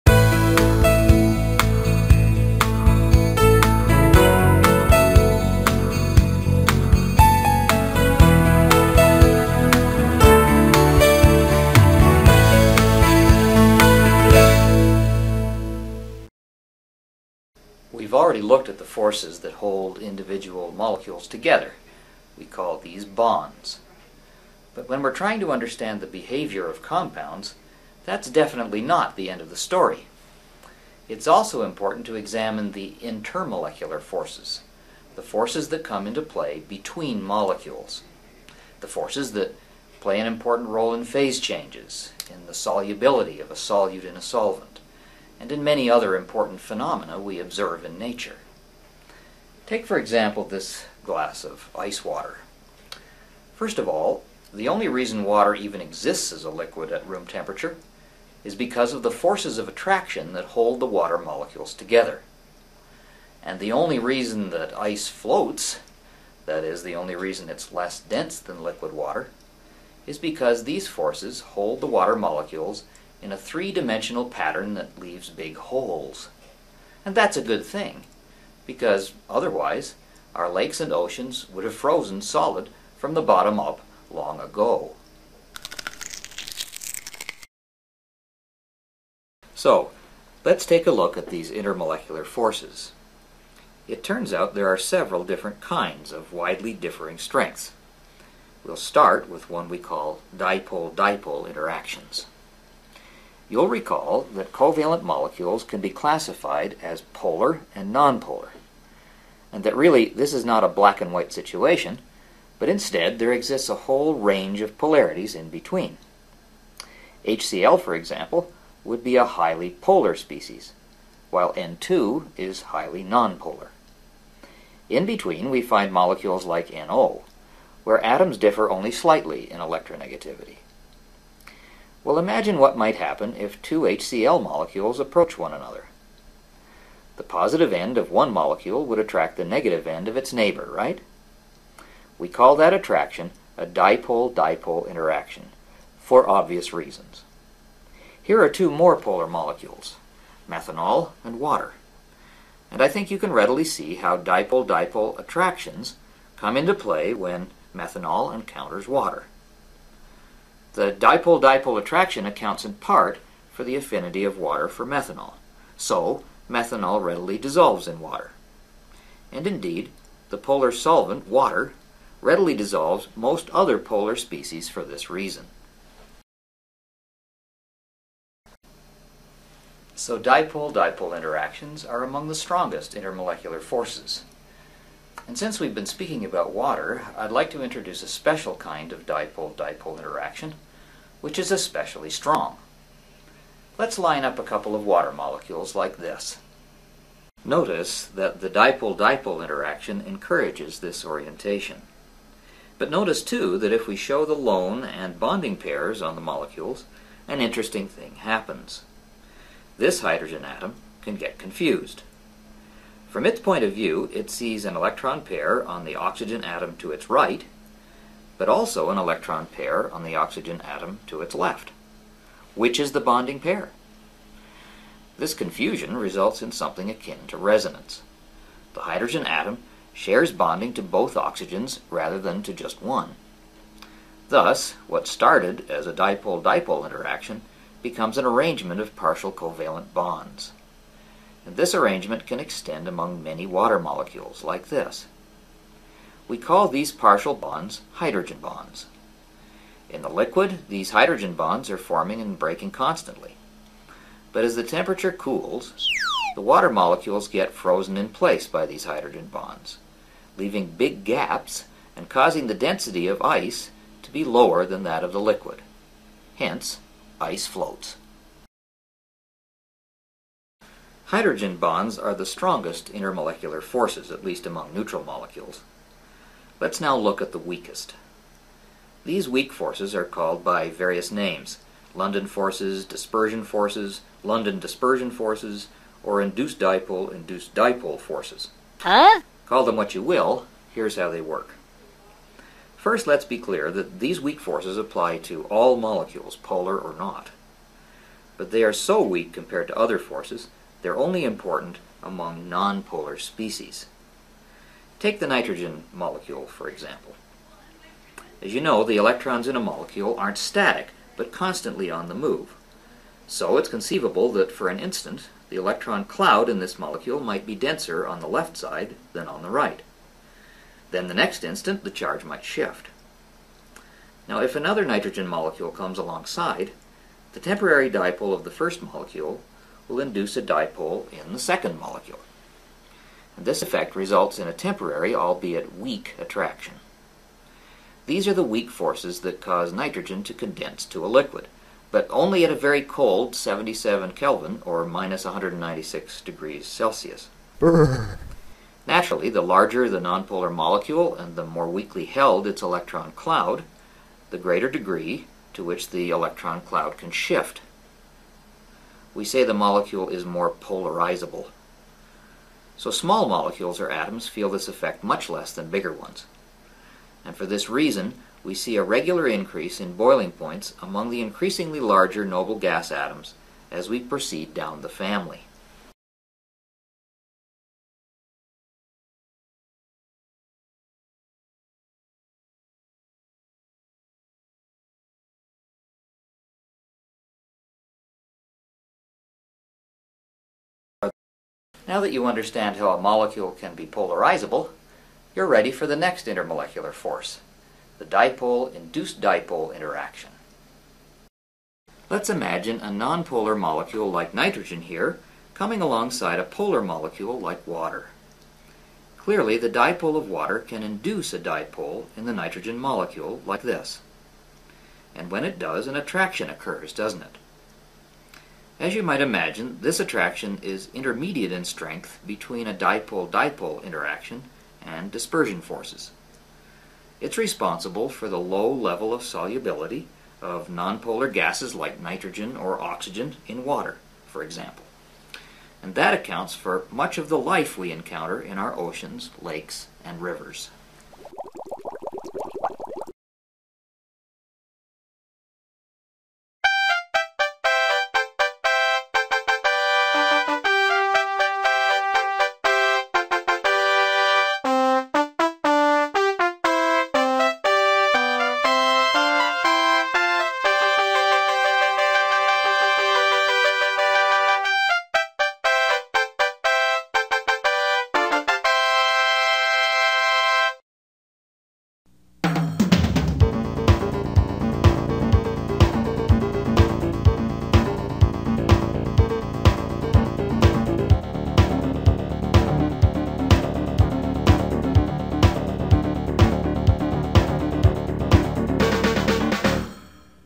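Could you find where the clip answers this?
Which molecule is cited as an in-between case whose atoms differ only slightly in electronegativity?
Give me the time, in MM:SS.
02:06.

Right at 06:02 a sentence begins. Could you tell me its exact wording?
So small molecules or atoms feel this effect much less than bigger ones.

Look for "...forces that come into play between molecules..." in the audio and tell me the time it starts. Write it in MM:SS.
00:35.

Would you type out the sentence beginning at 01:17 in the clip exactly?
And that's a good thing, because otherwise our lakes and oceans would have frozen solid from the bottom up long ago.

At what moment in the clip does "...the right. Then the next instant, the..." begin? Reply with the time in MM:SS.
05:19.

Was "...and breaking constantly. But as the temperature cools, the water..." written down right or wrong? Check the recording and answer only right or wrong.
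right.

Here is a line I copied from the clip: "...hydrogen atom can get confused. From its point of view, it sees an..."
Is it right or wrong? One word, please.
right.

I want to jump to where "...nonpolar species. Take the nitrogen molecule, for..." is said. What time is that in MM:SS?
05:02.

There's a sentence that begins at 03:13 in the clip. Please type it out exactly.
Let's line up a couple of water molecules like this.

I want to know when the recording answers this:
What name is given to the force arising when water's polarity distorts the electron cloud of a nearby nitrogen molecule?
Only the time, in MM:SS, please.
06:38.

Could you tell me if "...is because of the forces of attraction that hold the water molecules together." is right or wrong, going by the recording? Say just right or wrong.
right.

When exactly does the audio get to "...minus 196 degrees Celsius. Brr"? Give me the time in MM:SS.
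05:44.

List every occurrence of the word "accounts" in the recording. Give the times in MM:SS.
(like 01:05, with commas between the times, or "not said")
02:42, 07:16.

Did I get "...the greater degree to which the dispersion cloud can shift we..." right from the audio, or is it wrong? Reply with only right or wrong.
wrong.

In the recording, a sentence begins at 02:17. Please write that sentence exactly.
The positive end of one molecule would attract the negative end of its neighbor, right?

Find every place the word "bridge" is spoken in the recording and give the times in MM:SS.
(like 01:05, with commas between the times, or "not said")
not said.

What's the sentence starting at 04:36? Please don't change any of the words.
Let's now look at the weakest.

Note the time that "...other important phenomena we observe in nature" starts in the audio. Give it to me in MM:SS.
00:45.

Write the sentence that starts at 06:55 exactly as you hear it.
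And when it does, an attraction occurs, doesn't it?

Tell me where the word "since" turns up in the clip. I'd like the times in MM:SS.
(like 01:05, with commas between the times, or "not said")
03:05.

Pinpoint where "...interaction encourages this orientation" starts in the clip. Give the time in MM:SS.
03:19.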